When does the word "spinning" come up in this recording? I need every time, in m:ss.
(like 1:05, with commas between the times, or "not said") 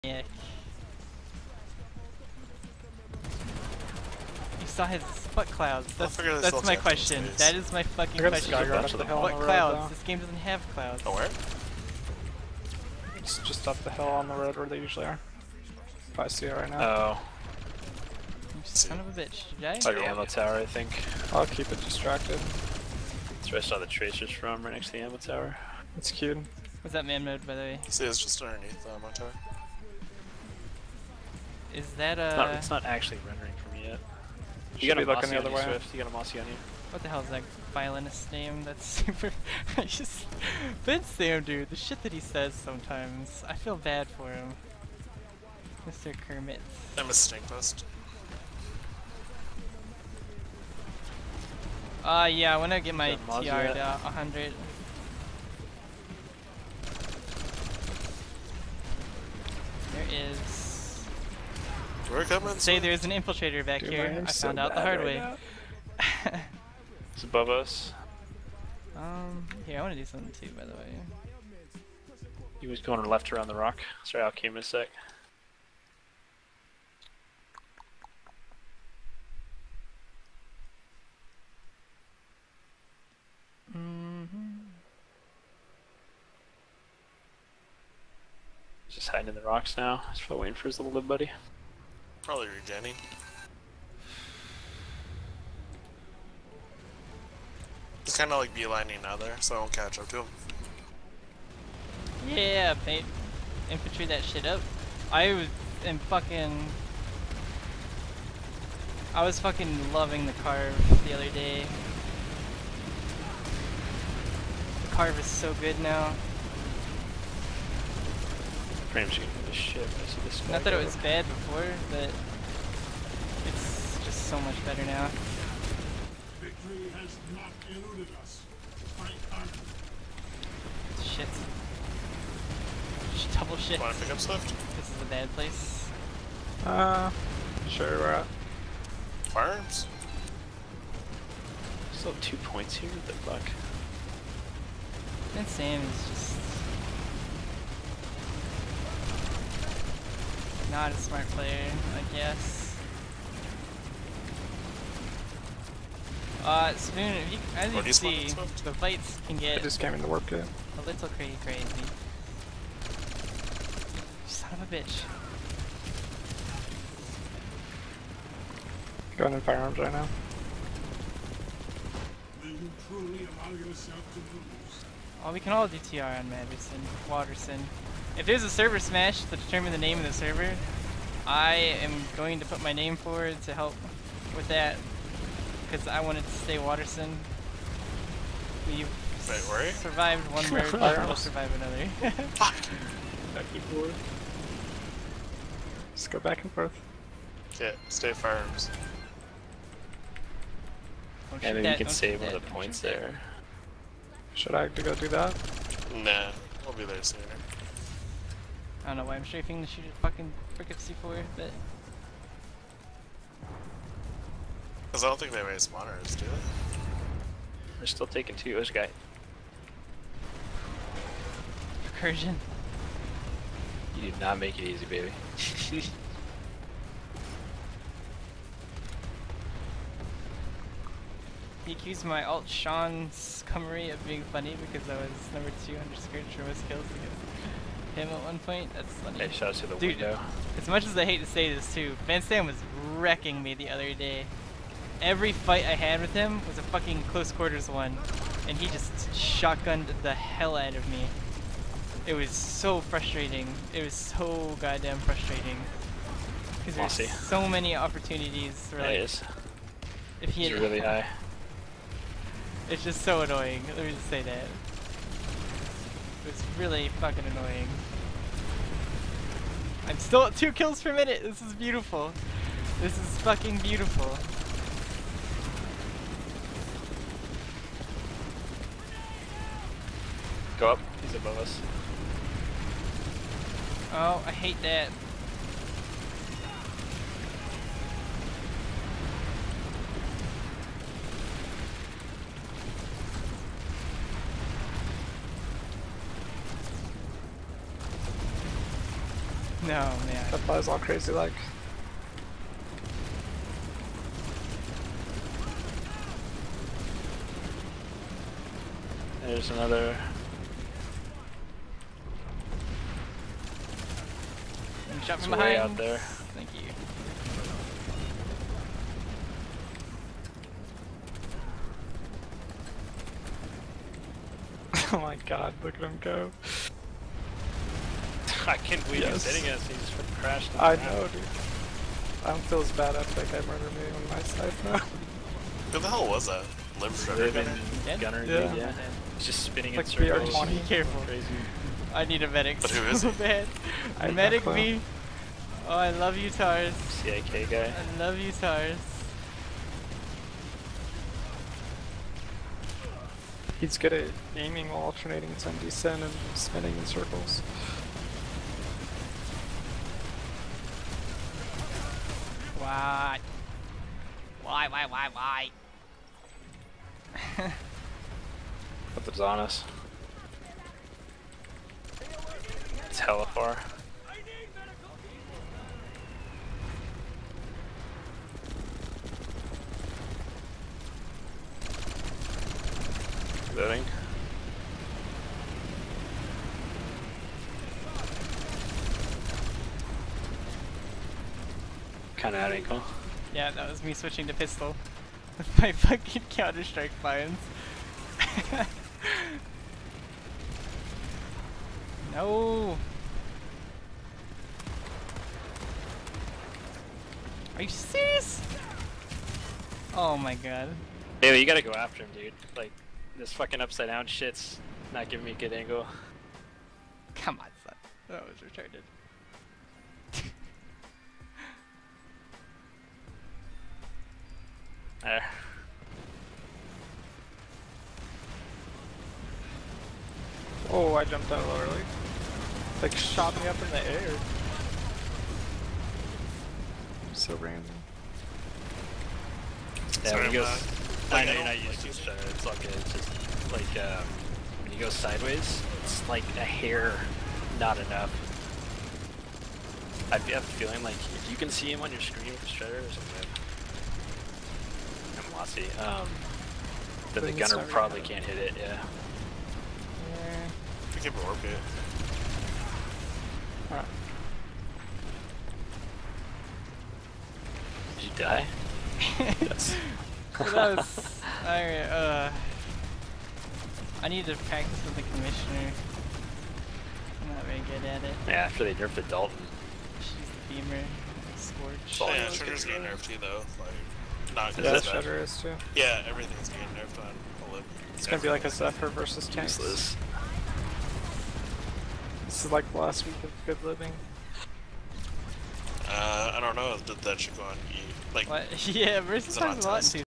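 5:39, 5:56.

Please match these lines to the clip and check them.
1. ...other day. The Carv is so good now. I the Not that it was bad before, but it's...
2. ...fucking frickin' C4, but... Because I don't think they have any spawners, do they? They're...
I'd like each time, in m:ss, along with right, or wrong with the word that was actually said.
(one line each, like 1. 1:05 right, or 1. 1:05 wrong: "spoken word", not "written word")
1. 1:51 right
2. 3:30 right.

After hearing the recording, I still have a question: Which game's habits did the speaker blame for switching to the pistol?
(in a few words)
Counter Strike.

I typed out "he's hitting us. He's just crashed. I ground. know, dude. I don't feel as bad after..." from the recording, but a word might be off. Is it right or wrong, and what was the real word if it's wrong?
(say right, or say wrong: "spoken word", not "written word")
right.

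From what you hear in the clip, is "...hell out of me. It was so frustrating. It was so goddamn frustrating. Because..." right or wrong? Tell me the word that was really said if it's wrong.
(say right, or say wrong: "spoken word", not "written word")
right.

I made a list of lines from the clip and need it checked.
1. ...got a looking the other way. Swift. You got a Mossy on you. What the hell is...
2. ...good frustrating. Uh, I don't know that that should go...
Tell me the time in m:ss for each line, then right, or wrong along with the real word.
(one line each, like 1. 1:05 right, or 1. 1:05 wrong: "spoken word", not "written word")
1. 0:34 right
2. 8:13 wrong: "living", not "frustrating".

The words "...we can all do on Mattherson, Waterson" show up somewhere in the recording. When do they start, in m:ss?
2:55.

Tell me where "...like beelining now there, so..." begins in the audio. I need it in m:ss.
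1:38.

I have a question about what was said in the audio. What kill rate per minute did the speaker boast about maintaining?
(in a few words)
2.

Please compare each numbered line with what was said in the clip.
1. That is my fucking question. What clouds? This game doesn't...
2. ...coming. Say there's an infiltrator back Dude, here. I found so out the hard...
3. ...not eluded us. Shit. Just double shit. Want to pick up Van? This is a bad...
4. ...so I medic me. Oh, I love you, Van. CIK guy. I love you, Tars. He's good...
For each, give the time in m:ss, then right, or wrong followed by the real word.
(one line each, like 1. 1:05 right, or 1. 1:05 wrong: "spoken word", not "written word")
1. 0:07 right
2. 1:02 right
3. 2:07 wrong: "Swift", not "Van"
4. 5:43 wrong: "Tars", not "Van".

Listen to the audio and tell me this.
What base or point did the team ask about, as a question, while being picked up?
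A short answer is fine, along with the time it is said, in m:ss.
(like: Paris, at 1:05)
Farms, at 2:19.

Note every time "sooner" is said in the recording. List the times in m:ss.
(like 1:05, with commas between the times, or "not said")
3:27.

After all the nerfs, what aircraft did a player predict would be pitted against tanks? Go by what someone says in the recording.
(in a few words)
Zephyr.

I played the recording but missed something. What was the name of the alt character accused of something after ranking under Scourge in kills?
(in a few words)
Sean Cummery.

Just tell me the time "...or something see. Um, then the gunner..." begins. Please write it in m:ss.
7:32.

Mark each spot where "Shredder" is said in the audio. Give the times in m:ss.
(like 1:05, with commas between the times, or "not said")
5:36, 7:32.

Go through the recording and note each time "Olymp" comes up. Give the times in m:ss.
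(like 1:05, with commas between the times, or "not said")
8:07.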